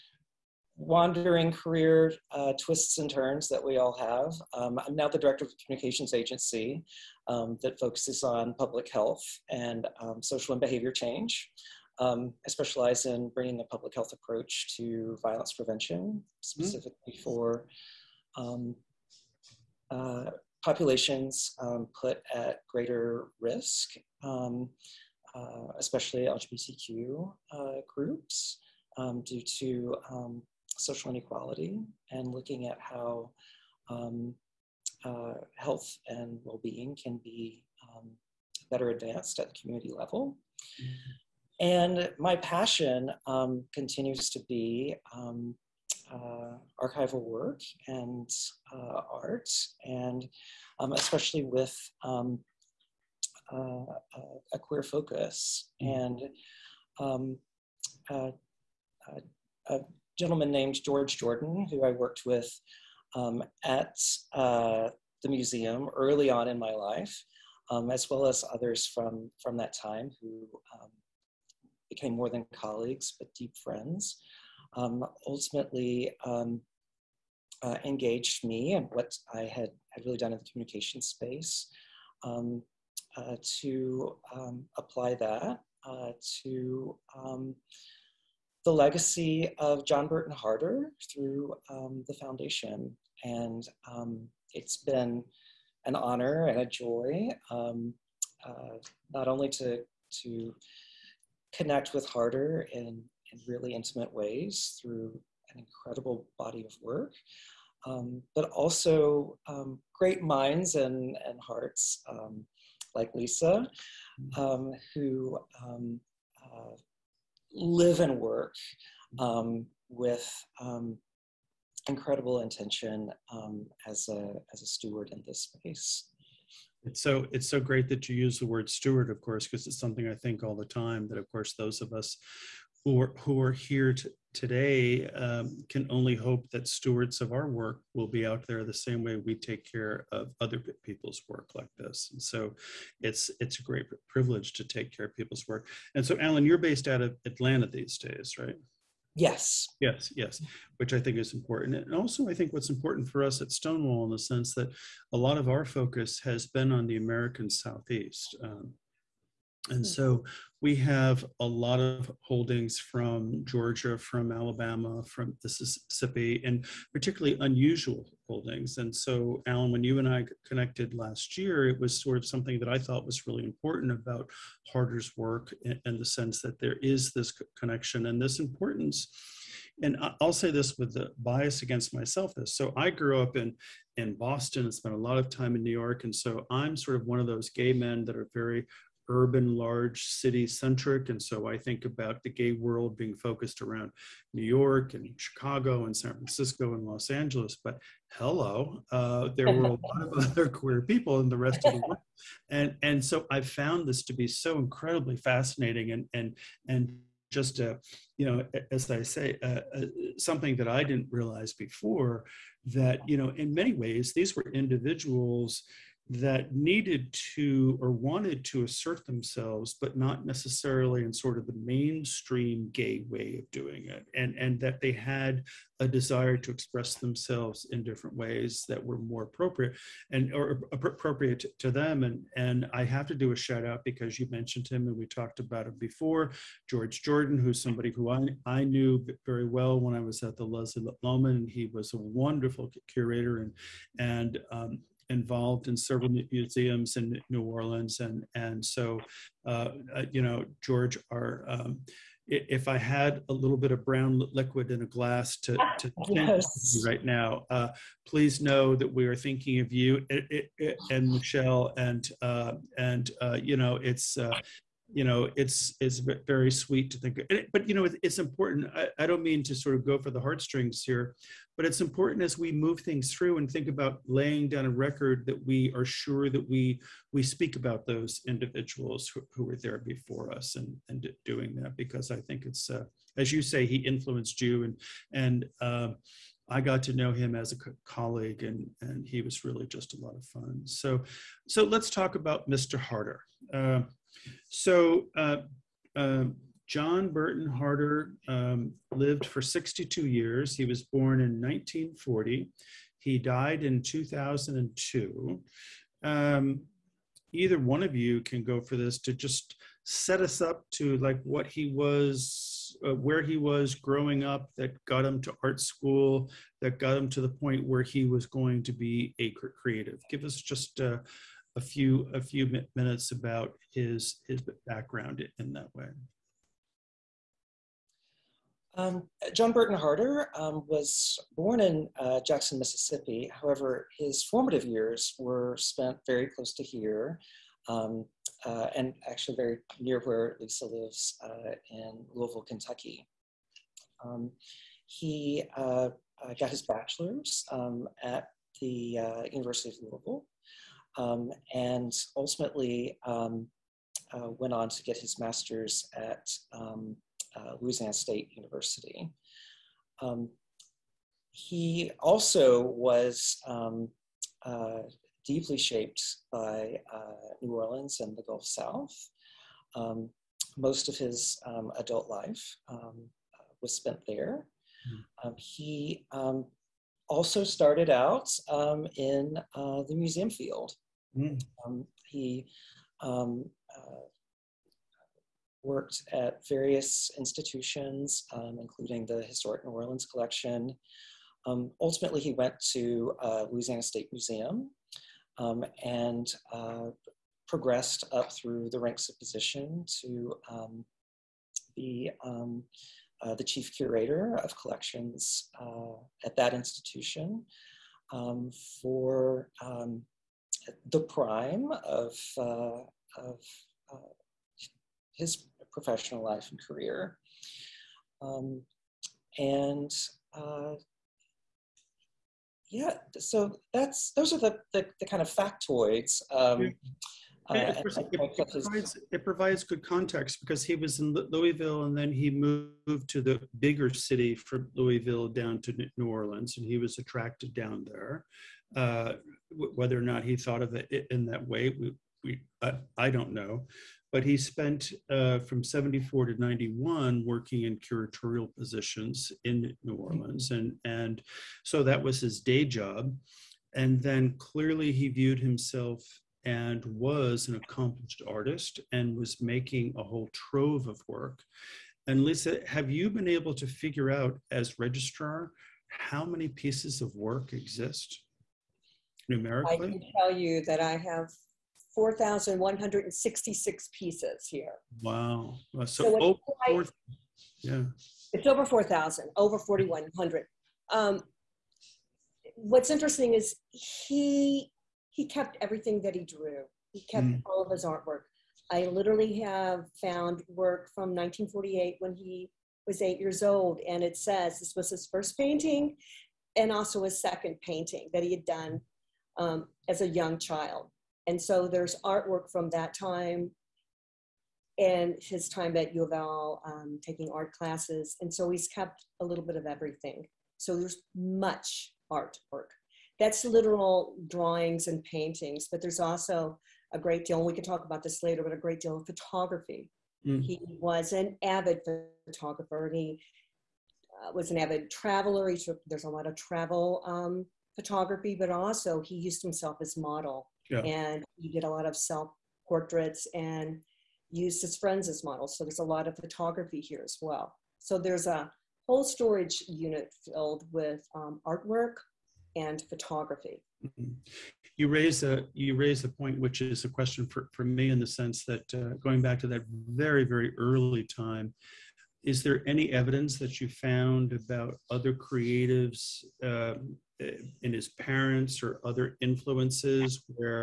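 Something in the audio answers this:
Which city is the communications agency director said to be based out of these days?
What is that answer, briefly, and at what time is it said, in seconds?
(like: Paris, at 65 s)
Atlanta, at 147 s.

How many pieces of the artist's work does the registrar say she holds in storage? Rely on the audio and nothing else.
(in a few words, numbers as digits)
4,166.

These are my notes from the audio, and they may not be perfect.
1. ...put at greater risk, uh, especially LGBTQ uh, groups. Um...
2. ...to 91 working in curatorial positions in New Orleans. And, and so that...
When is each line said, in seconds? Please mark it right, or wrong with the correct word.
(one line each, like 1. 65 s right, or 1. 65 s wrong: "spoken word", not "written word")
1. 21 s right
2. 446 s right.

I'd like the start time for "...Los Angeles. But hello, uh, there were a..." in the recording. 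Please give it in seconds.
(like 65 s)
196 s.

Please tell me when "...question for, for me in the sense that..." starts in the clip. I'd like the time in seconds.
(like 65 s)
546 s.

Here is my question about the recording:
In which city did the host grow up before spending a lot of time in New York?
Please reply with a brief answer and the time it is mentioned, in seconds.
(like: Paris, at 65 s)
Boston, at 184 s.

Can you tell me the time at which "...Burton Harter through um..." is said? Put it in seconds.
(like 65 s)
90 s.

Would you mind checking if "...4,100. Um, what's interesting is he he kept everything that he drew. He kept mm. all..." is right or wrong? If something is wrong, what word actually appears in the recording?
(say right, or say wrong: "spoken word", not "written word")
right.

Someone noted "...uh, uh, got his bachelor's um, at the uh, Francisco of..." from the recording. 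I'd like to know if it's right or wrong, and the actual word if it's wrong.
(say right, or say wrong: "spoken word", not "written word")
wrong: "University", not "Francisco".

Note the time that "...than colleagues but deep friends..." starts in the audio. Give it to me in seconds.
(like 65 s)
72 s.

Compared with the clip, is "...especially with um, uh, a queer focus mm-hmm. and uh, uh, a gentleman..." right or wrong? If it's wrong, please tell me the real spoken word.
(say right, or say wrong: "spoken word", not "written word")
right.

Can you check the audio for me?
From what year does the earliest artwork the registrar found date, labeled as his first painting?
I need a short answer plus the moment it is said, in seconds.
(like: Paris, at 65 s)
1948, at 491 s.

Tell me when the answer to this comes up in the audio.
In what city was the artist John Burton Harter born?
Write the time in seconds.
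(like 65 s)
332 s.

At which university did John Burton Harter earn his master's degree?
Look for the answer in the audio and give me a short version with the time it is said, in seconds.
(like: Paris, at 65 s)
Louisiana State University, at 357 s.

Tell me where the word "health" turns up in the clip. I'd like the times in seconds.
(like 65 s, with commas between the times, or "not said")
8 s, 13 s, 35 s.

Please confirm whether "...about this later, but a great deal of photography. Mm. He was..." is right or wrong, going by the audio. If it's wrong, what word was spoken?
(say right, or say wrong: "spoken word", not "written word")
right.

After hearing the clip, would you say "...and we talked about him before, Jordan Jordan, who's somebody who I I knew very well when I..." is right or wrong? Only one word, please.
wrong.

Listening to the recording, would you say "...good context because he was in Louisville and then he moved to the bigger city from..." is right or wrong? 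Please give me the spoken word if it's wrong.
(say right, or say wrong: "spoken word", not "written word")
right.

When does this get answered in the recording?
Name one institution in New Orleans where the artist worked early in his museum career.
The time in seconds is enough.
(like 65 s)
389 s.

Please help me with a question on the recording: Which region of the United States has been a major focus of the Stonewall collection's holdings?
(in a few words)
American Southeast.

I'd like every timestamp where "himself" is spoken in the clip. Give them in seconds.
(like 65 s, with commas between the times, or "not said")
455 s, 529 s.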